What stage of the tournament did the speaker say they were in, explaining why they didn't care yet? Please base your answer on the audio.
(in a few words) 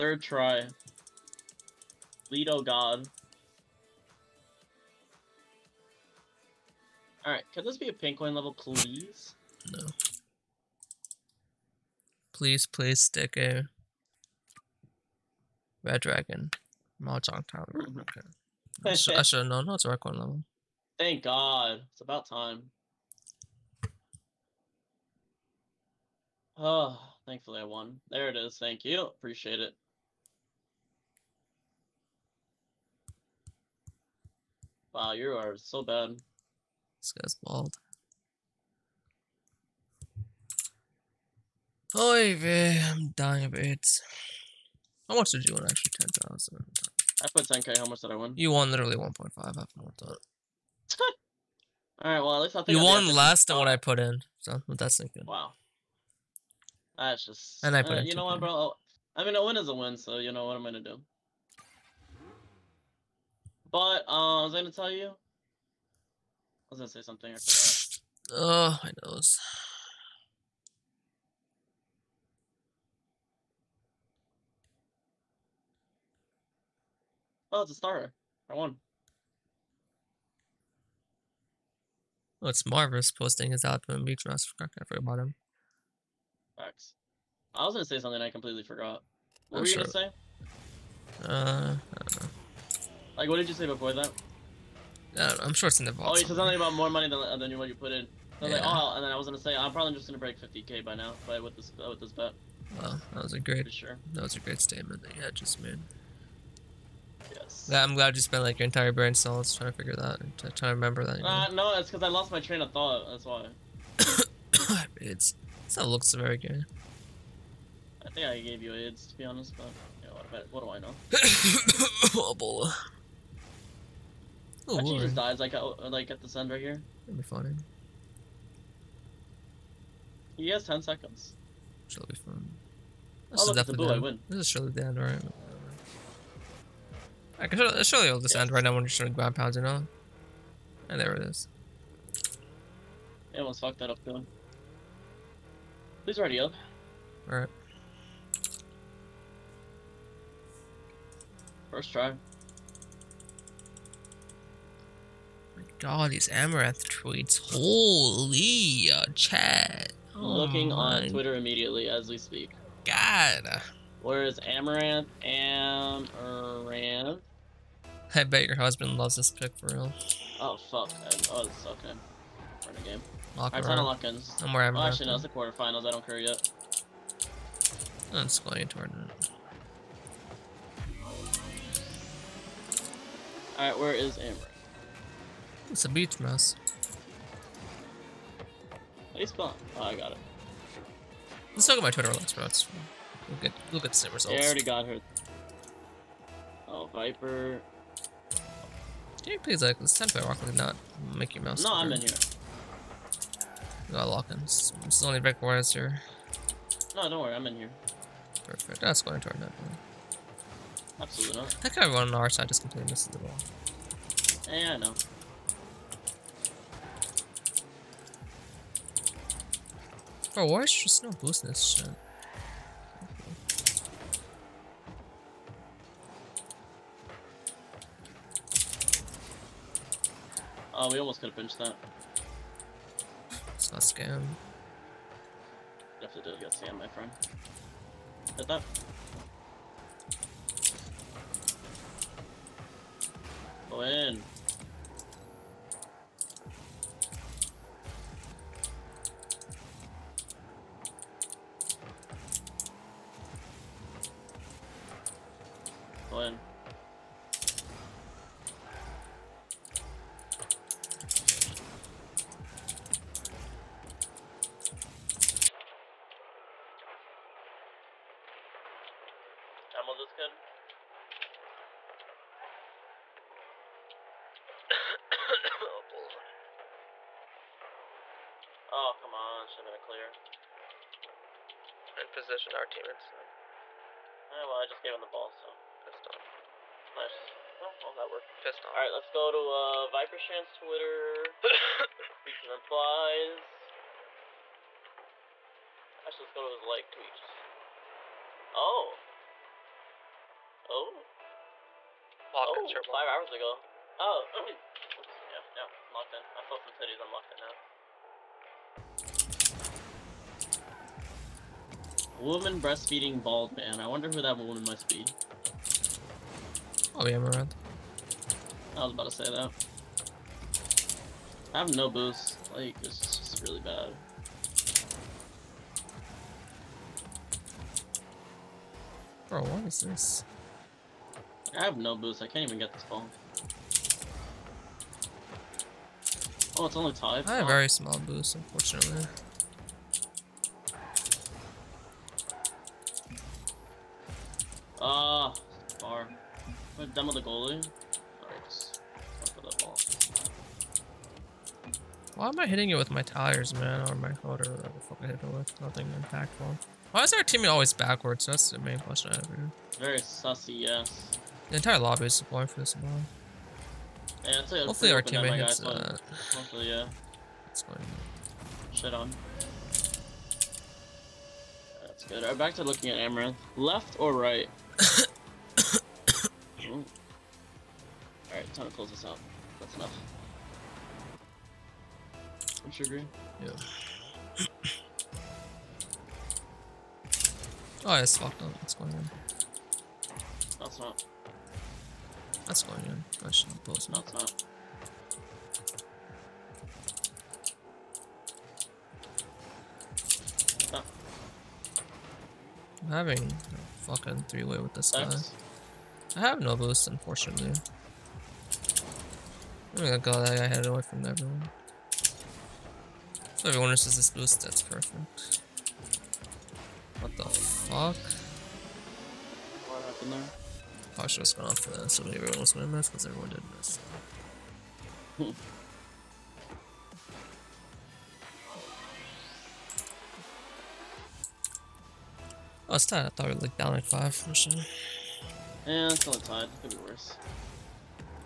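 Quarterfinals.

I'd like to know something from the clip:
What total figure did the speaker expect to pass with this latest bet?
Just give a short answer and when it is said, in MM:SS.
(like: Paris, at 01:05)
50k, at 01:40.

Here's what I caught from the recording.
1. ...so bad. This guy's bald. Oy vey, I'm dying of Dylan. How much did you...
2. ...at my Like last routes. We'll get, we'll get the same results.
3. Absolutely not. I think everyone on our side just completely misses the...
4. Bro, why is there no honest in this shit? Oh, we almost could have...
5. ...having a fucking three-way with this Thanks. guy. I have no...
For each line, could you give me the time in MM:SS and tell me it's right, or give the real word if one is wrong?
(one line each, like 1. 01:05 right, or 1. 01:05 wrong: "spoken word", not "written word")
1. 00:35 wrong: "AIDS", not "Dylan"
2. 03:11 wrong: "Twitter", not "Like"
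3. 03:30 right
4. 03:40 wrong: "boost", not "honest"
5. 06:42 right.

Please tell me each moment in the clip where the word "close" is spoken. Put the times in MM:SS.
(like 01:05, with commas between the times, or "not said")
06:18.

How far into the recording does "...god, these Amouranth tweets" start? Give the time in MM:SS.
02:35.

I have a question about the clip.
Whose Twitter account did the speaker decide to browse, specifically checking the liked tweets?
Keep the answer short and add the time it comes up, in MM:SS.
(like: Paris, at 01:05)
ViperShan, at 04:49.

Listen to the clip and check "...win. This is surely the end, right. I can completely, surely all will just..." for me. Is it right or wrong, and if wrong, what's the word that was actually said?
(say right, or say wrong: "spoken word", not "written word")
wrong: "surely", not "completely".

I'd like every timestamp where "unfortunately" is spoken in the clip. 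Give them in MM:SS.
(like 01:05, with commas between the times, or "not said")
05:38, 06:46.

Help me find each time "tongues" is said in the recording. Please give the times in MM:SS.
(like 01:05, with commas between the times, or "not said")
not said.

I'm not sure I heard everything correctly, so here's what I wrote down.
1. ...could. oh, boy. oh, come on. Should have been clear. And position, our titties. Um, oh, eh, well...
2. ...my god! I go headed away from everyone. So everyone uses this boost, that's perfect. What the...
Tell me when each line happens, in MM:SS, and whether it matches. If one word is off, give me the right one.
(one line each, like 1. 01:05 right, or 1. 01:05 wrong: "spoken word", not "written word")
1. 04:30 wrong: "teammates", not "titties"
2. 06:49 right.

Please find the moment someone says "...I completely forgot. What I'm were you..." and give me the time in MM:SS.
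01:28.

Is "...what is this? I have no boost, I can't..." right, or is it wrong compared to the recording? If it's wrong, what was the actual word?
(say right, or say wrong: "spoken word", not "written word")
right.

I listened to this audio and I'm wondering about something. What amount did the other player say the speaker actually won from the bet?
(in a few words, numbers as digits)
1.5.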